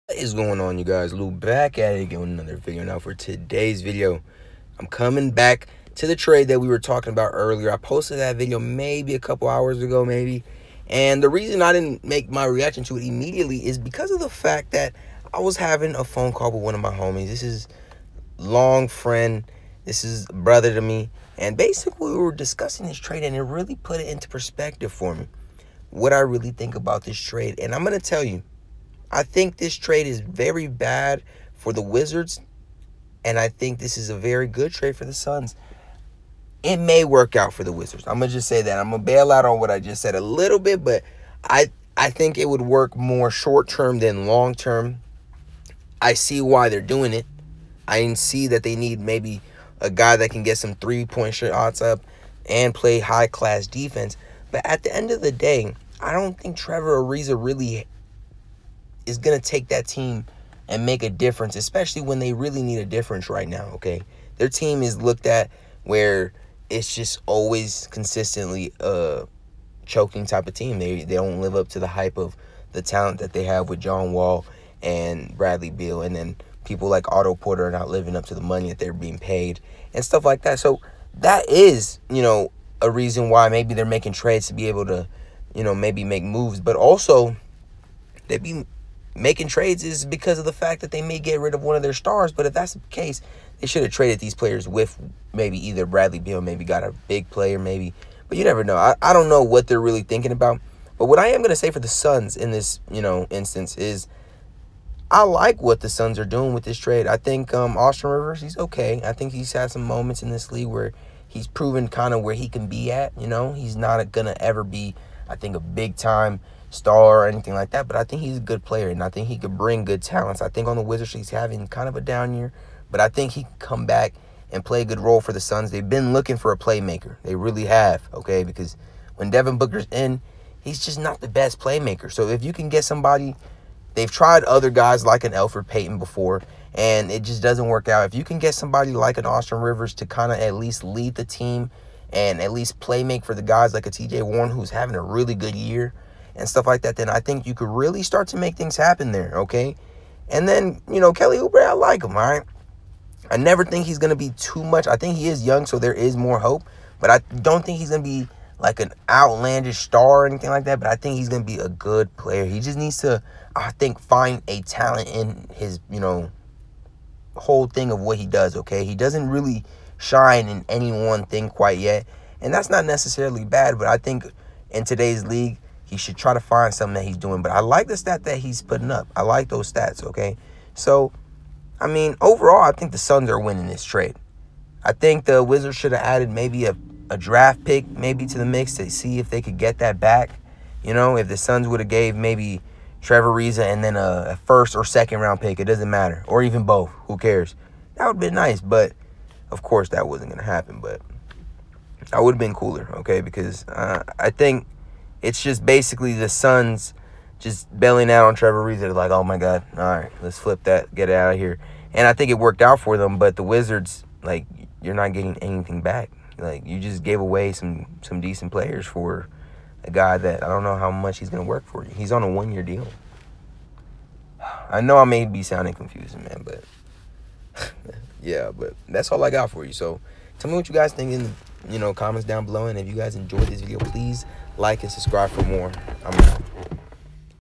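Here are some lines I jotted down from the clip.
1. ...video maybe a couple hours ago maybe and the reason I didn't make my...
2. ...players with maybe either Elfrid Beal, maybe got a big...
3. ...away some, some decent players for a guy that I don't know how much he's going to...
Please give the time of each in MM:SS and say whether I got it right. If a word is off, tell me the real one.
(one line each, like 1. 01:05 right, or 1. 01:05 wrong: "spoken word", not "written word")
1. 00:08 right
2. 01:34 wrong: "Bradley", not "Elfrid"
3. 03:37 right.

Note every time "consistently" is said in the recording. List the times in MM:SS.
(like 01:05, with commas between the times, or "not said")
01:07.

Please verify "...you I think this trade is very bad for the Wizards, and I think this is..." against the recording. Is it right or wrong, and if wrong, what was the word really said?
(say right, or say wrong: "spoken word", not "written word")
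right.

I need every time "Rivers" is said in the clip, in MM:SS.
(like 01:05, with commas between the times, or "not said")
01:48, 02:19.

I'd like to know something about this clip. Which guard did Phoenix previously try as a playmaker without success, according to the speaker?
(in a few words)
Elfrid Payton.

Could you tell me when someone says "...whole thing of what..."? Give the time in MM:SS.
02:47.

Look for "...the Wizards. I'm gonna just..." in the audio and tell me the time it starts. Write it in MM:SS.
00:37.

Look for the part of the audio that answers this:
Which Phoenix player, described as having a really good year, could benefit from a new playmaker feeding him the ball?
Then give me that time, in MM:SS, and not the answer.
02:23.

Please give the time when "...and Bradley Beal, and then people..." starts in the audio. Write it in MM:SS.
01:14.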